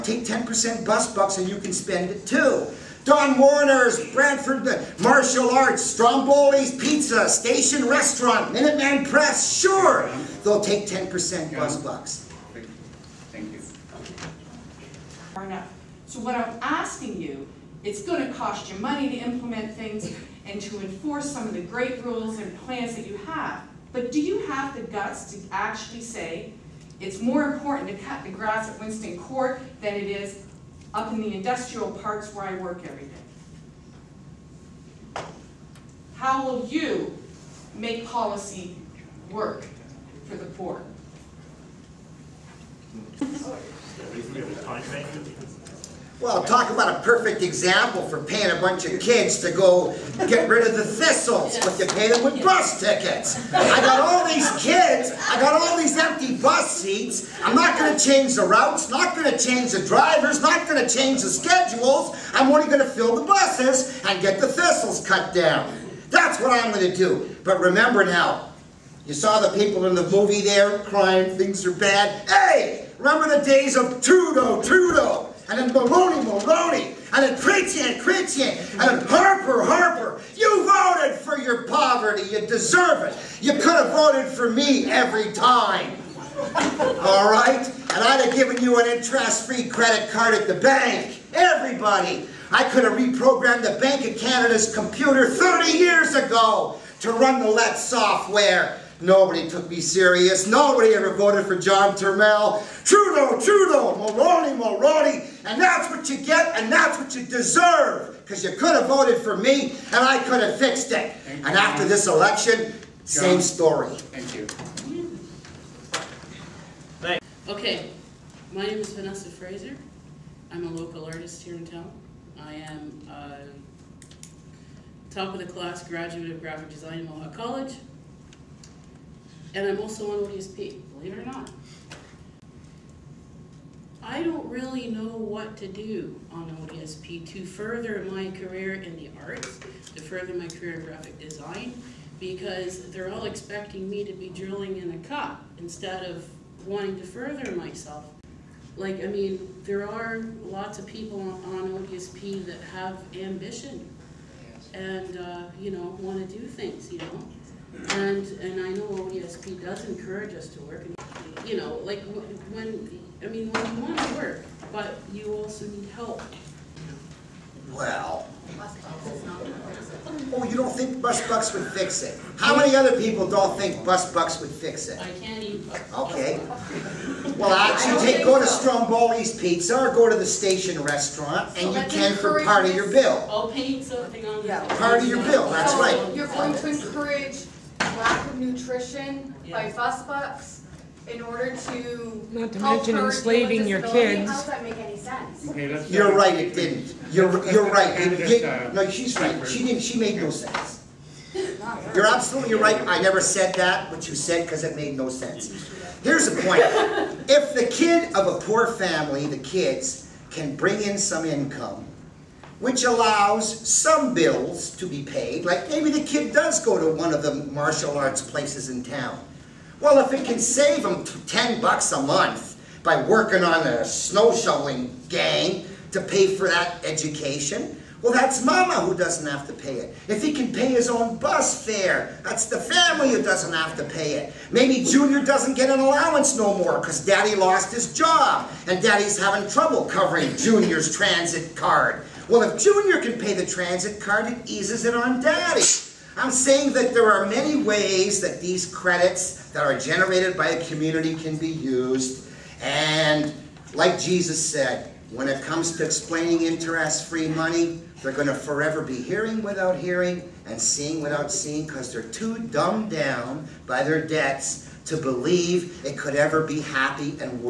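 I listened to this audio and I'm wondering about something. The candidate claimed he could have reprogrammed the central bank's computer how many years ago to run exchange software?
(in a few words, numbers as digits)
30.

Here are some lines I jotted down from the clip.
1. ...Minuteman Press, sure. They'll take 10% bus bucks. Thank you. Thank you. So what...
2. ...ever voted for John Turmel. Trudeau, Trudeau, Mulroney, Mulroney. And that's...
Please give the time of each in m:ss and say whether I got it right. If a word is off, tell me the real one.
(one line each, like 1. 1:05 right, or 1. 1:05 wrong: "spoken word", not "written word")
1. 0:08 right
2. 1:40 right.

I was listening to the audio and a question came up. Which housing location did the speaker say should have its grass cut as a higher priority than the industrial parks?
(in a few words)
Winston Court.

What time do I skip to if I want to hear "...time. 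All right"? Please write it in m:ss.
1:25.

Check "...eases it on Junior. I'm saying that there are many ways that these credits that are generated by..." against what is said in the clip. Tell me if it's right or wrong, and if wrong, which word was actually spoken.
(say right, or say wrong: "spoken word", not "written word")
wrong: "Daddy", not "Junior".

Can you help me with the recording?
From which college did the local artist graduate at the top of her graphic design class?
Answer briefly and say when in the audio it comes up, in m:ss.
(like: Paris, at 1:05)
Mohawk College, at 2:07.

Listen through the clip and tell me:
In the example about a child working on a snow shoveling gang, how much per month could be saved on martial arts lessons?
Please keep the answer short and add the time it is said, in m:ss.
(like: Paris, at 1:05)
10 bucks, at 3:41.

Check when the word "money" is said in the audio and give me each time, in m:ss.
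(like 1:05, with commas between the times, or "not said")
0:18, 4:17.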